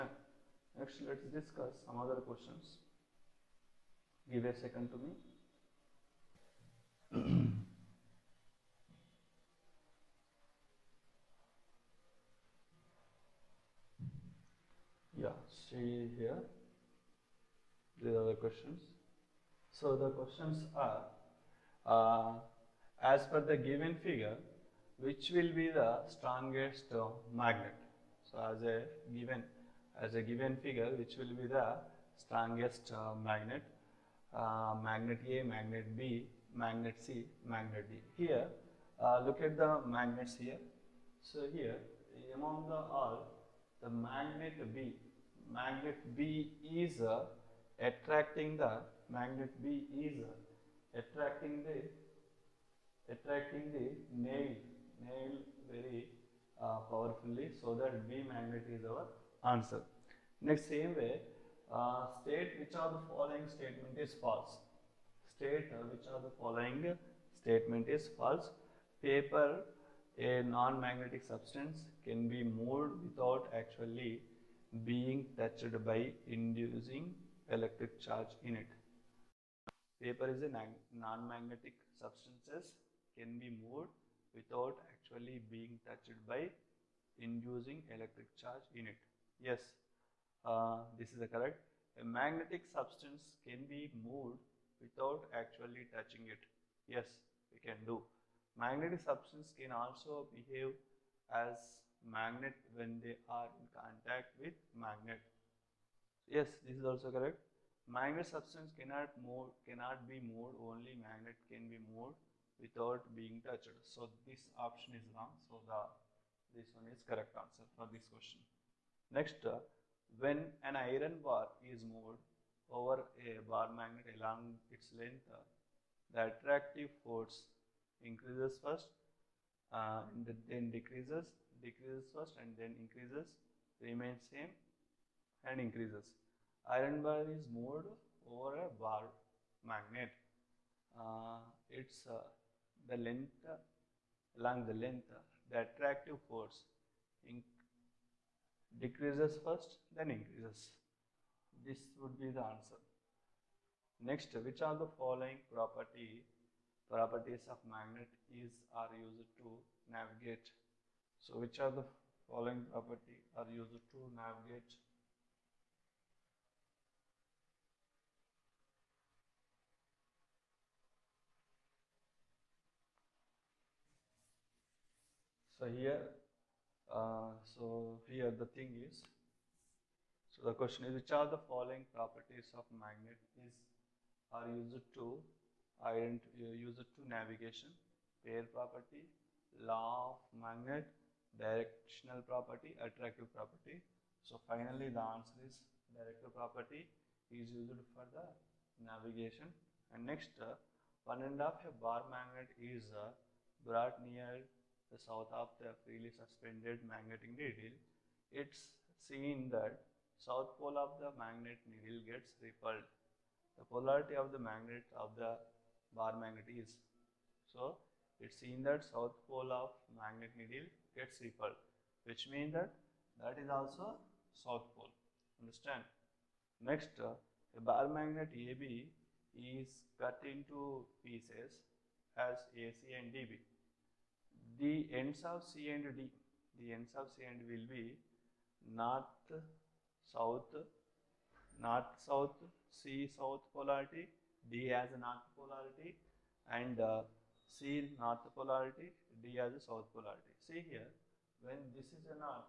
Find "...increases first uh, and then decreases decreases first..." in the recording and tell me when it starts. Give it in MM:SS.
02:08.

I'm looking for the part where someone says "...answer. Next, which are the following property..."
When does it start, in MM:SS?
02:32.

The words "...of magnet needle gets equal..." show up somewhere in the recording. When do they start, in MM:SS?
03:39.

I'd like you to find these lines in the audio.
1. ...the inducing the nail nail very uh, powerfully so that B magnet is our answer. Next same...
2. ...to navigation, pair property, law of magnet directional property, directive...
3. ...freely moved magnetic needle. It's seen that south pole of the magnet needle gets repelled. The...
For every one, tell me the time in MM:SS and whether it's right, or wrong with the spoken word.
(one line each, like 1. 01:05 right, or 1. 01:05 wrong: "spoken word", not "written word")
1. 00:51 wrong: "attracting", not "inducing"
2. 03:06 wrong: "attractive", not "directive"
3. 03:25 wrong: "suspended", not "moved".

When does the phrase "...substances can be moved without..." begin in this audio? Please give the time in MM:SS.
01:21.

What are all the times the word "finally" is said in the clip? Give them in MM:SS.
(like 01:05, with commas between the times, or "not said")
03:14.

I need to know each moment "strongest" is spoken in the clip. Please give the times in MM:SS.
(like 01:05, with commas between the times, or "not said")
00:26, 00:32.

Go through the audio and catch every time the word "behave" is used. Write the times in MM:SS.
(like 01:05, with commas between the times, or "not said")
01:40.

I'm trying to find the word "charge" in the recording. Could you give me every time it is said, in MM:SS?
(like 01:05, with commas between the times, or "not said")
01:17, 01:28.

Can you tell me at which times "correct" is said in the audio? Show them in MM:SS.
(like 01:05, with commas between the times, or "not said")
01:31, 01:47, 01:57.